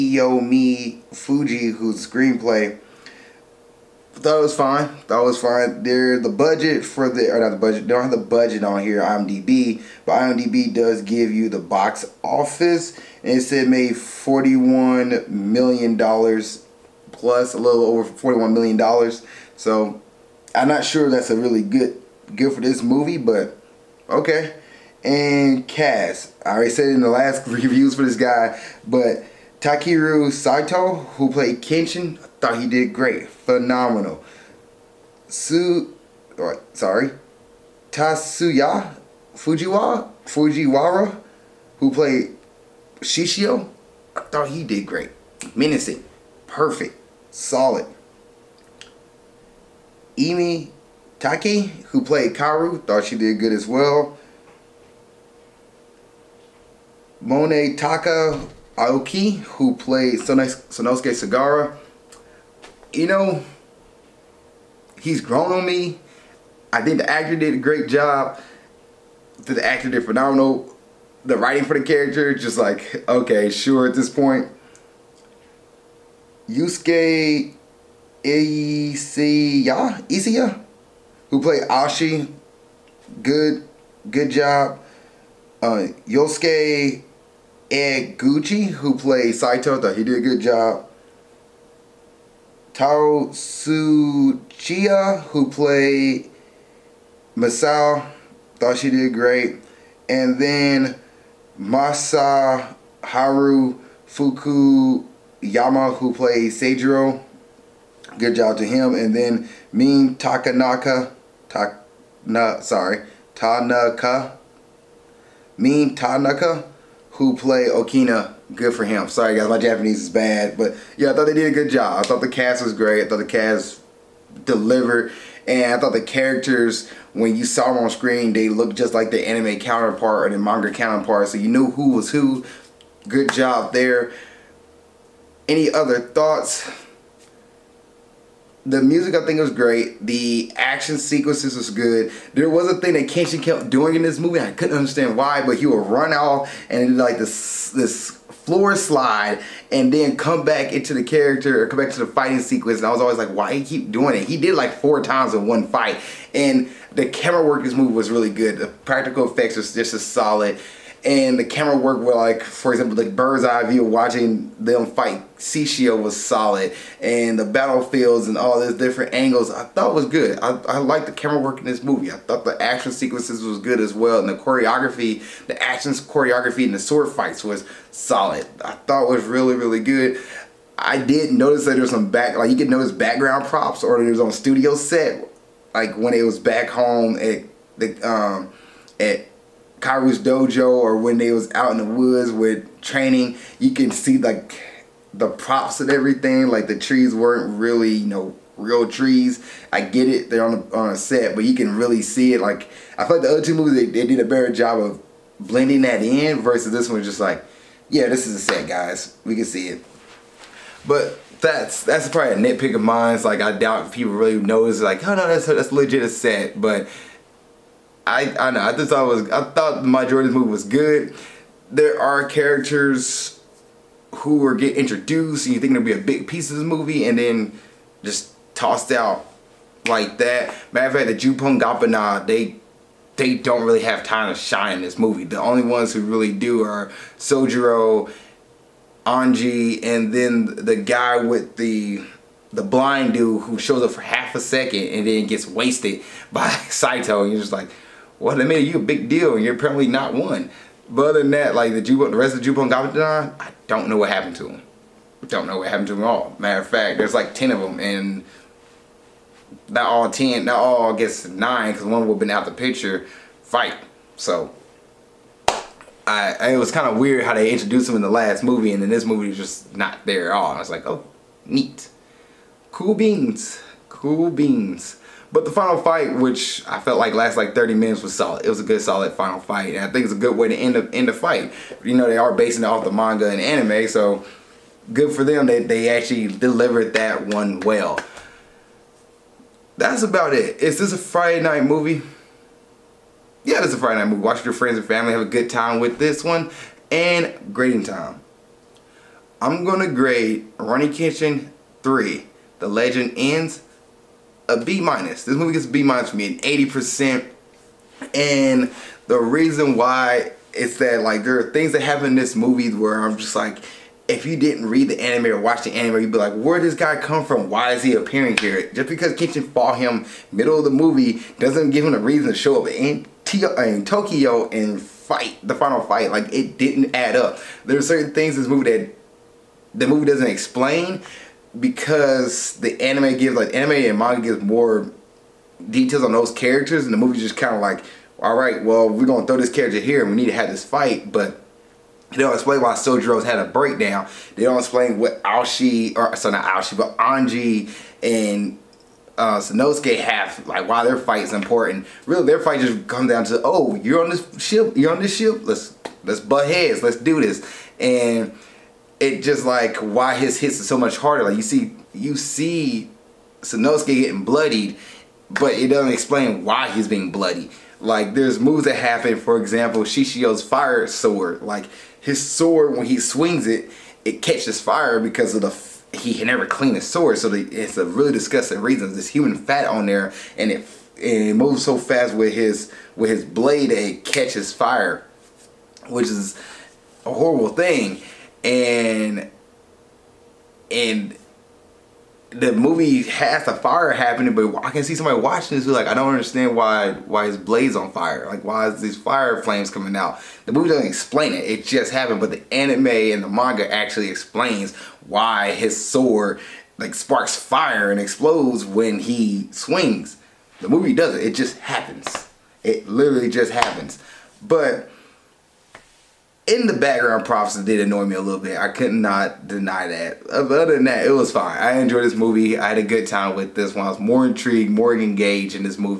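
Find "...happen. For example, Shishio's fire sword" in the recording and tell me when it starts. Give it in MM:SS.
06:08.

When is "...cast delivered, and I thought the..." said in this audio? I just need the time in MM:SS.
02:03.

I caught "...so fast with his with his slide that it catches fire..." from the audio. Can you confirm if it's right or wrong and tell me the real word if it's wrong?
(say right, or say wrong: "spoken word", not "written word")
wrong: "blade", not "slide".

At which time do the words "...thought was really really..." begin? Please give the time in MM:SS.
02:58.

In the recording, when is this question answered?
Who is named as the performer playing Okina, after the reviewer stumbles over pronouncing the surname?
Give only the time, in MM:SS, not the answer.
01:55.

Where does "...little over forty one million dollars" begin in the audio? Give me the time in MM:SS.
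00:17.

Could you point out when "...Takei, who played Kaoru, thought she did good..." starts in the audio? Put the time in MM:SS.
00:51.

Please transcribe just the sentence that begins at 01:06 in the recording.
I think the actor did a great job.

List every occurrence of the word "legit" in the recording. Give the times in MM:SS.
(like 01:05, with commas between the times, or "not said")
03:35.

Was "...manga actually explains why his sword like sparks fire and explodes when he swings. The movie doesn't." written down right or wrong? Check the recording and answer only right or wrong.
right.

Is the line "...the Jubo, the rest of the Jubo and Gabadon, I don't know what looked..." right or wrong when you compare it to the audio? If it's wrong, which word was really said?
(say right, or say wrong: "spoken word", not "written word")
wrong: "happened", not "looked".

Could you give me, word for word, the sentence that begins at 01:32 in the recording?
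Tao Tsuchiya, who played Masao, thought she did great.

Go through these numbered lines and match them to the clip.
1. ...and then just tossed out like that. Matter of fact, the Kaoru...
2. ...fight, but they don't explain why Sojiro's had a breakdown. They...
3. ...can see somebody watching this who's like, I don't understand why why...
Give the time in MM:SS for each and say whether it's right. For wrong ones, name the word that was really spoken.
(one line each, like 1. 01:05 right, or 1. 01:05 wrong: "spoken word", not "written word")
1. 03:47 wrong: "Juppongatana", not "Kaoru"
2. 05:40 right
3. 06:34 right.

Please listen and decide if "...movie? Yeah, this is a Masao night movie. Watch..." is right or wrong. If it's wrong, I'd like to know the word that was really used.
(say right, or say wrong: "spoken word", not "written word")
wrong: "Friday", not "Masao".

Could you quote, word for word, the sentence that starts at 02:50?
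I, I liked the camera work in this movie.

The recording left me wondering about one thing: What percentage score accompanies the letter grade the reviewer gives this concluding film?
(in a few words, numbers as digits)
80%.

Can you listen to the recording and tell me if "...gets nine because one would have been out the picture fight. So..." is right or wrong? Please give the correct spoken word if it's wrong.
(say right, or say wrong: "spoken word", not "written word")
right.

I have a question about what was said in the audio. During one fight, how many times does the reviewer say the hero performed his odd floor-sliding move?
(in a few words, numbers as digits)
4.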